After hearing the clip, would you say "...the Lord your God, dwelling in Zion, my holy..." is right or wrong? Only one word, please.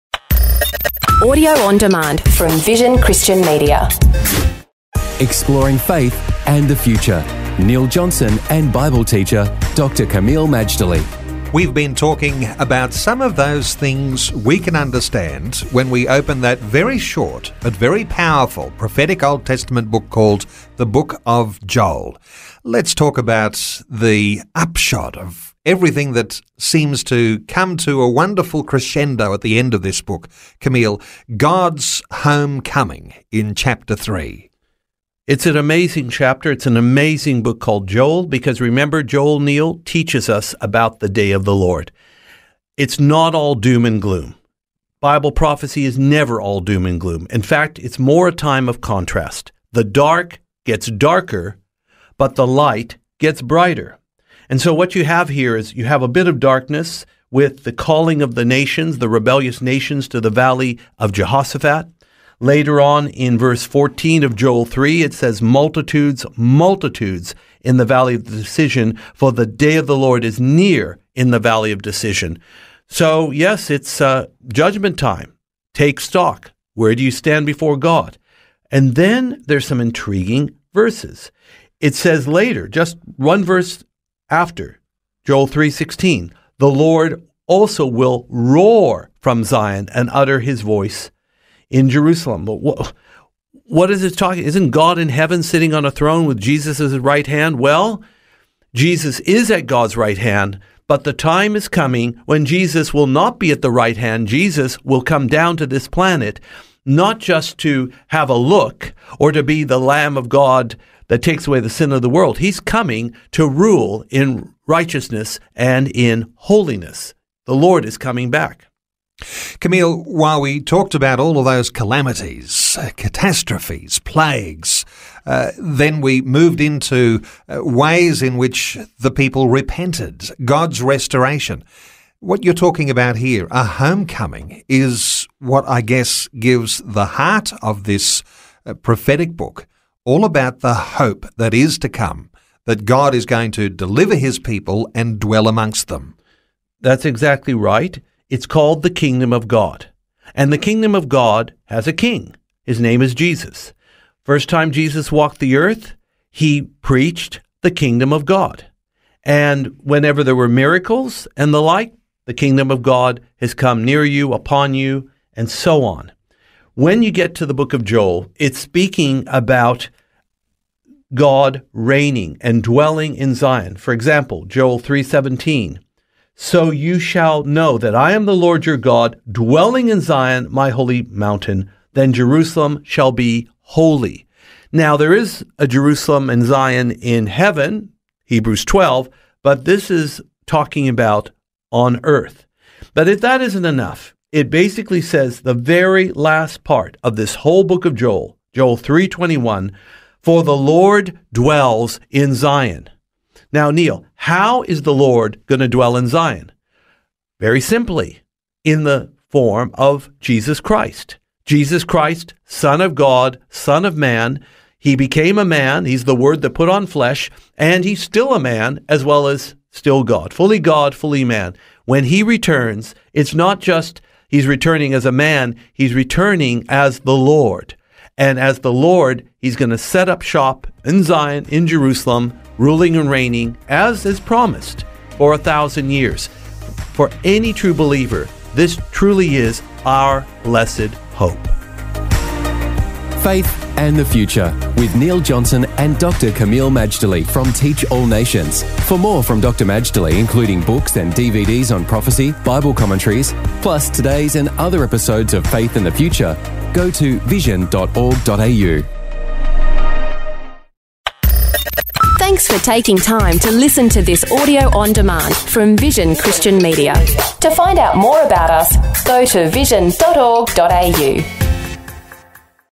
right.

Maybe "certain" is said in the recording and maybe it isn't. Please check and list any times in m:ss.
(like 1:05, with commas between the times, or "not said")
not said.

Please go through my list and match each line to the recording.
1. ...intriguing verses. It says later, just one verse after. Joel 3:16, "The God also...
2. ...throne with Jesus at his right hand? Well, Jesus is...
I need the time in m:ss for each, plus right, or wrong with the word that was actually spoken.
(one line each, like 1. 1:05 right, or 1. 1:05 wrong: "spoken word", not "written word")
1. 1:19 wrong: "Lord", not "God"
2. 1:35 right.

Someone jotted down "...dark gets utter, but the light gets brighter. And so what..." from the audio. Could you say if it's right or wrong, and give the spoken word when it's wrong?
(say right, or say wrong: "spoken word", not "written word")
wrong: "darker", not "utter".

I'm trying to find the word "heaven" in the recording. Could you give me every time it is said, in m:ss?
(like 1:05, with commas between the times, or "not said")
1:35, 3:07.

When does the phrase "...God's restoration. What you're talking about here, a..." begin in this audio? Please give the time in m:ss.
2:10.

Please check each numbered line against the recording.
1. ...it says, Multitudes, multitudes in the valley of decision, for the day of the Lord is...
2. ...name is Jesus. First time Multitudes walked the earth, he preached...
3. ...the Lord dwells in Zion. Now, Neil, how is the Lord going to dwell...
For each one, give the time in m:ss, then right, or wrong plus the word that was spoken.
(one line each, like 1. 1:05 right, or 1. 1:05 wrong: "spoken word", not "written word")
1. 1:05 right
2. 2:32 wrong: "Jesus", not "Multitudes"
3. 3:20 right.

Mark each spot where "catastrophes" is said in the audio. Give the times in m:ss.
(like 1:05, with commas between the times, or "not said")
2:02.